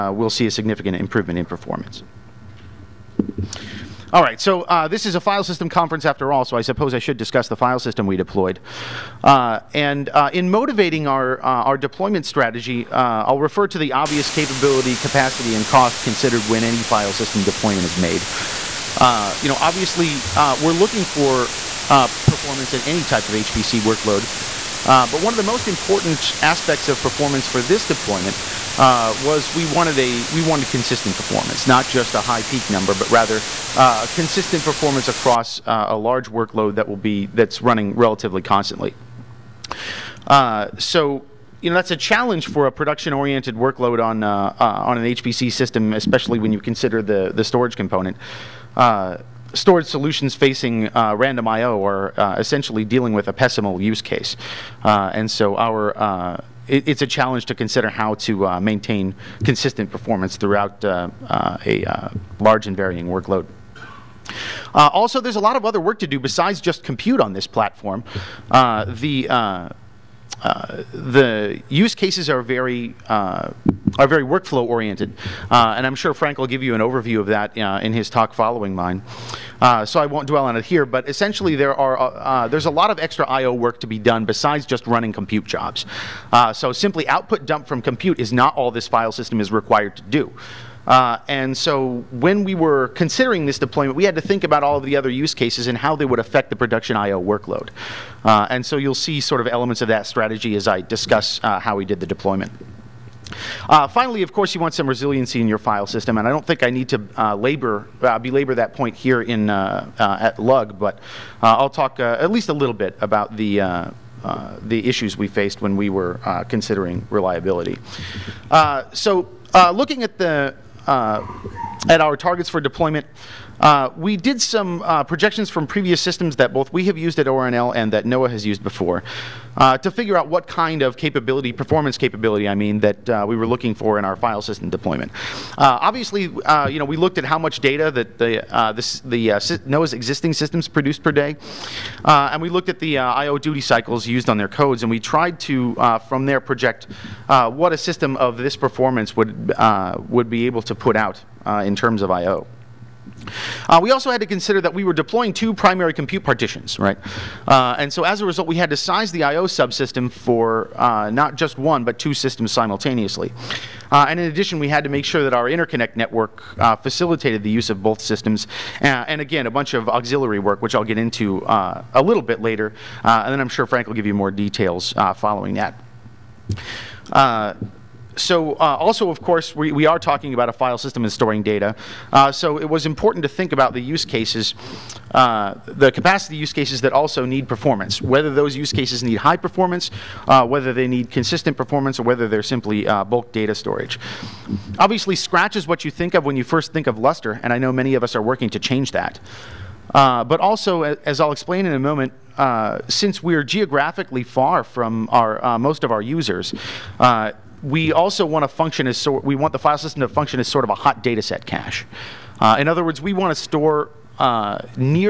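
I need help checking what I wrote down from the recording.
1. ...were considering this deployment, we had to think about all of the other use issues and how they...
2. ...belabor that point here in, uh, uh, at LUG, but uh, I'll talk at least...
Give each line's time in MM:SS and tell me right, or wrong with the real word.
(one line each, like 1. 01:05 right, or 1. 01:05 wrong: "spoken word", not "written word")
1. 01:32 wrong: "cases", not "issues"
2. 01:48 right.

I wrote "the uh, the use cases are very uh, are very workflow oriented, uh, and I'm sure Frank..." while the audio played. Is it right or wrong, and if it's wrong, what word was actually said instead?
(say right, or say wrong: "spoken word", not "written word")
right.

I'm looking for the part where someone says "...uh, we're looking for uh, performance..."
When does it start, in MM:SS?
00:20.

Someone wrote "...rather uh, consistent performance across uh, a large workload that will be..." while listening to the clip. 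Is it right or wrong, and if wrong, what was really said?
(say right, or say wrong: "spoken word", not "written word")
right.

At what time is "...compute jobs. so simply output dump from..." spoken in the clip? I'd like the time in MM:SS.
01:25.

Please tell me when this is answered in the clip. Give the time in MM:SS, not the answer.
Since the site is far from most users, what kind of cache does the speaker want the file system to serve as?
03:30.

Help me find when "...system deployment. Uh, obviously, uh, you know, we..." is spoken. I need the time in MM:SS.
02:14.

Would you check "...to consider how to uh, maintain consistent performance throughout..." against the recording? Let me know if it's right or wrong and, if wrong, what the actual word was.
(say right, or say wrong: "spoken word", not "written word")
right.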